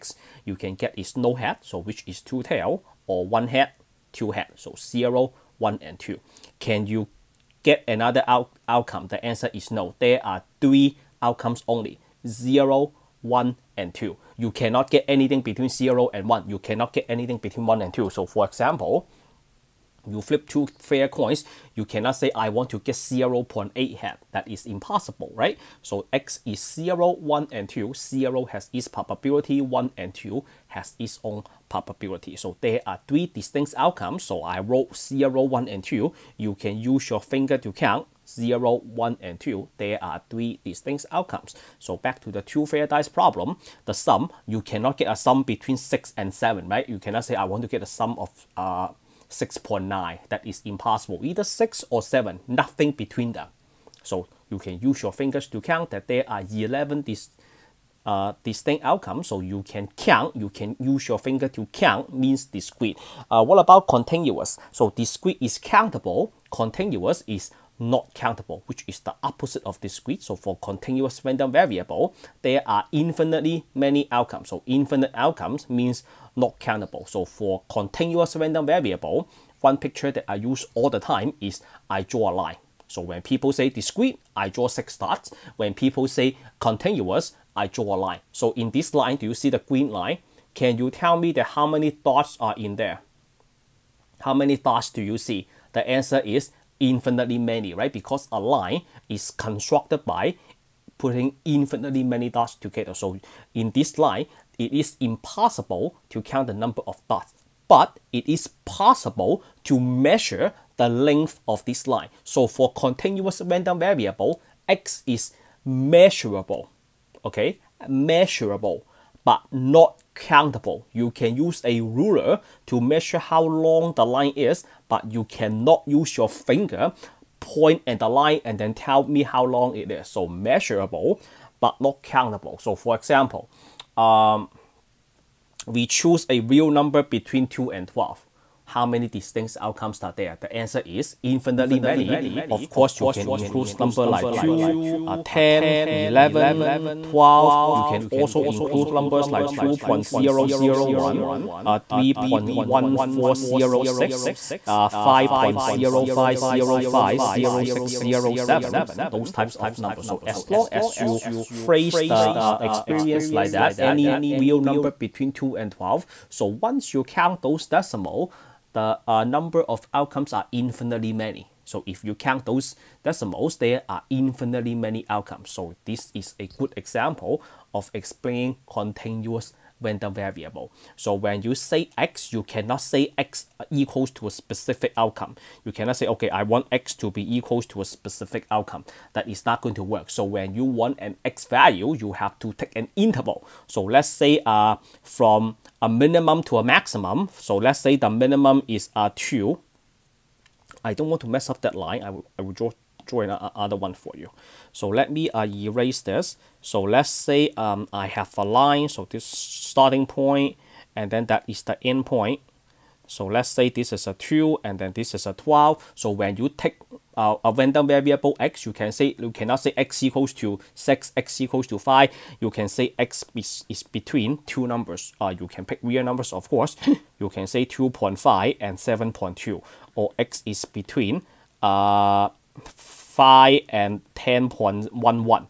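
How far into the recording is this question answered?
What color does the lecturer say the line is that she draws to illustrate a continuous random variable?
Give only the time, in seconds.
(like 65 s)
89 s.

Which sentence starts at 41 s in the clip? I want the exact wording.
So back to the two fair dice problem, the sum, you cannot get a sum between 6 and 7, right?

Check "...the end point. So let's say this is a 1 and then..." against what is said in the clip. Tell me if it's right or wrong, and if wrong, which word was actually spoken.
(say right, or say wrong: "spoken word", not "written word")
wrong: "2", not "1".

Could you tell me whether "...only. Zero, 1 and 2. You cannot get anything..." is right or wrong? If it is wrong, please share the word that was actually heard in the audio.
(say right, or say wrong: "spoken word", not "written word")
right.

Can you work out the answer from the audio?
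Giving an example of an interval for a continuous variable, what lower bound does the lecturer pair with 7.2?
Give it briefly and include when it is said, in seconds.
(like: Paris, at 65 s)
2.5, at 227 s.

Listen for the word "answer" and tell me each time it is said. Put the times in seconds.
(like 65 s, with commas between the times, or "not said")
9 s, 95 s, 140 s.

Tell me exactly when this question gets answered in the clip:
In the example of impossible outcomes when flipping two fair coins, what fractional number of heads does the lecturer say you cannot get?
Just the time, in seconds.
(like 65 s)
22 s.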